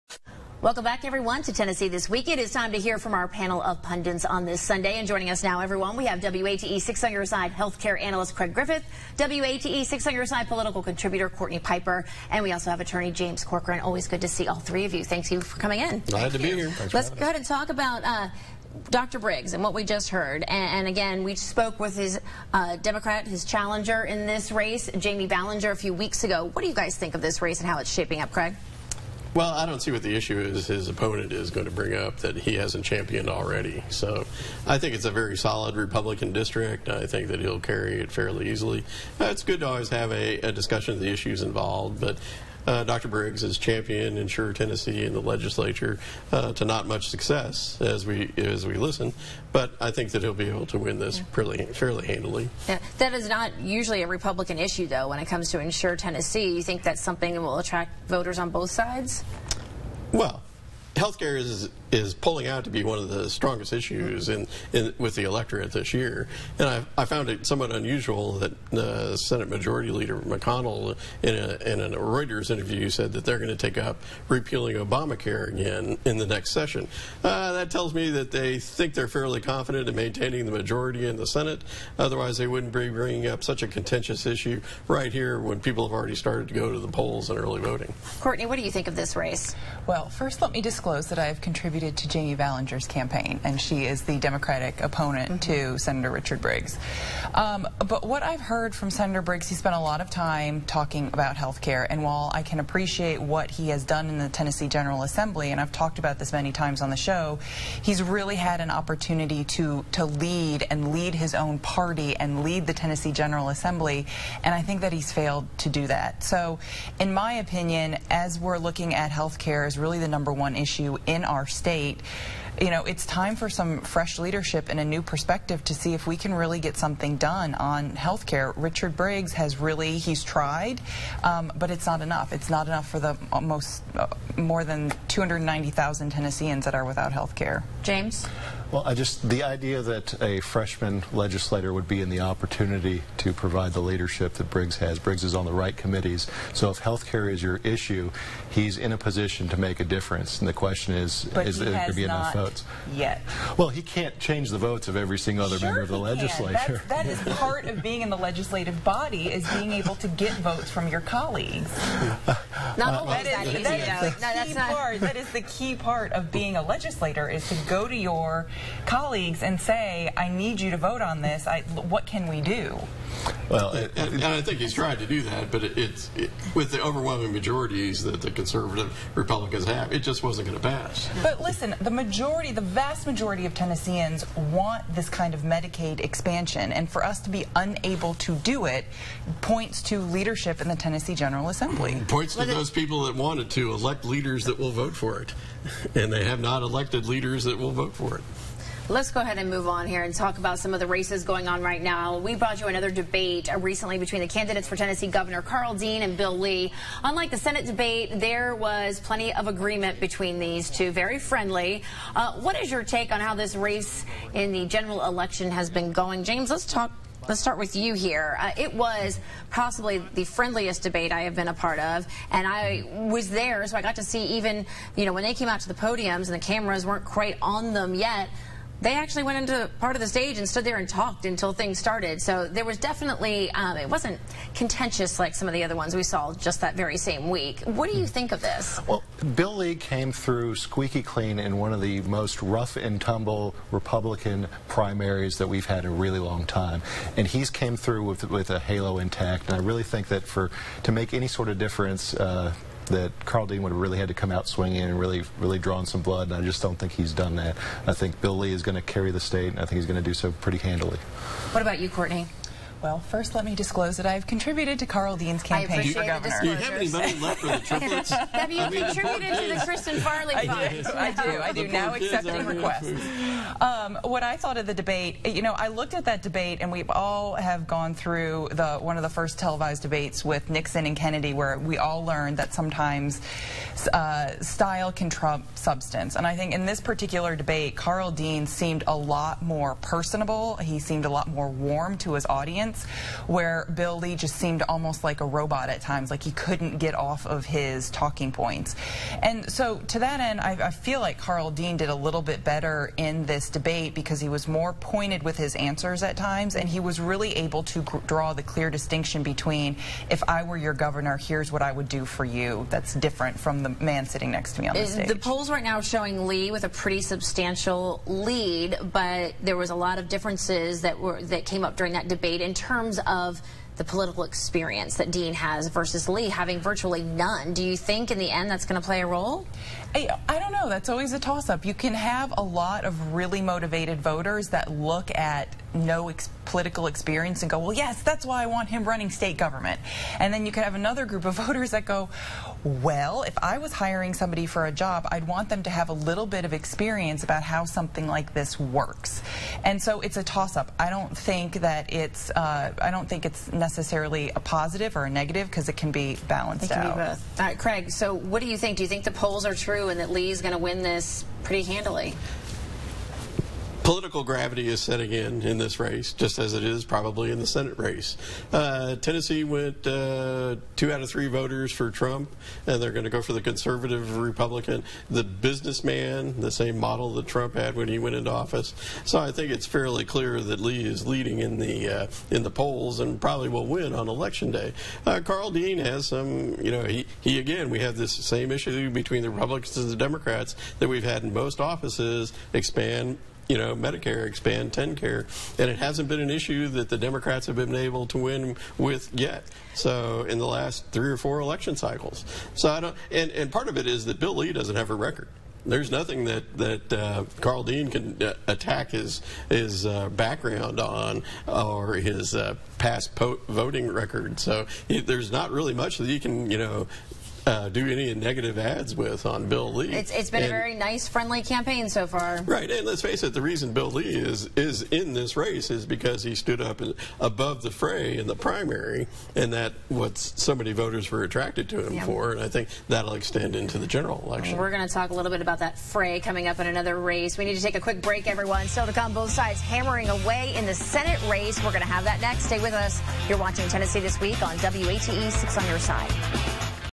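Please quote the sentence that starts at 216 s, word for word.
James, let's talk Let's start with you here.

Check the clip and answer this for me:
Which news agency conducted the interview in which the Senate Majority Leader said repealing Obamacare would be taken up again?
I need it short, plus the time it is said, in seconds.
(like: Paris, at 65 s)
Reuters, at 71 s.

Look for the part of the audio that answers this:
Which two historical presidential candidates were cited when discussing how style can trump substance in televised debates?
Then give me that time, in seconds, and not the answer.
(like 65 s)
280 s.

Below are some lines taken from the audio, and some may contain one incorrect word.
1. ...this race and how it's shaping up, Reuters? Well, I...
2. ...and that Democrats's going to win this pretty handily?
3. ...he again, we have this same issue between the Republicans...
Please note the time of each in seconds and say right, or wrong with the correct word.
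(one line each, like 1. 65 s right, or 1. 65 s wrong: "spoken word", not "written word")
1. 27 s wrong: "Craig", not "Reuters"
2. 359 s wrong: "Lee", not "Democrats"
3. 387 s right.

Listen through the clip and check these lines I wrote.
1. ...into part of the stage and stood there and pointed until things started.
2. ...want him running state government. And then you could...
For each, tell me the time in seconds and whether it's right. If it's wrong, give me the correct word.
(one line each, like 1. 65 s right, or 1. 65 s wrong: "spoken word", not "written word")
1. 229 s wrong: "talked", not "pointed"
2. 338 s right.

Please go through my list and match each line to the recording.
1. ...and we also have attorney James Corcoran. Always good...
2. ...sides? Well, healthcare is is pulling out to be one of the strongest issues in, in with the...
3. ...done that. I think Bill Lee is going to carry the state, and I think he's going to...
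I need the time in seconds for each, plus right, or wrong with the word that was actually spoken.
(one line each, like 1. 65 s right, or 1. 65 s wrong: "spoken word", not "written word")
1. 12 s right
2. 58 s right
3. 257 s right.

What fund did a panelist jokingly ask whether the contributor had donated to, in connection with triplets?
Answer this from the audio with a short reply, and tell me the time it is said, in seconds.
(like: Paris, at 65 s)
Kristen Farley Fund, at 269 s.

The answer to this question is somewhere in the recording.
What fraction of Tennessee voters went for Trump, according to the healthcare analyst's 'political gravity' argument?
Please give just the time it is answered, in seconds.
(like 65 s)
370 s.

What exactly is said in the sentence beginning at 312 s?
That's different from the man sitting next to me on the uh, stage.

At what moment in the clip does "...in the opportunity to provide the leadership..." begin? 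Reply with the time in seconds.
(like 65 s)
141 s.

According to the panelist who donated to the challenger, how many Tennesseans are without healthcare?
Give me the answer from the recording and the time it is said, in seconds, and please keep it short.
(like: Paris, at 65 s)
290,000, at 135 s.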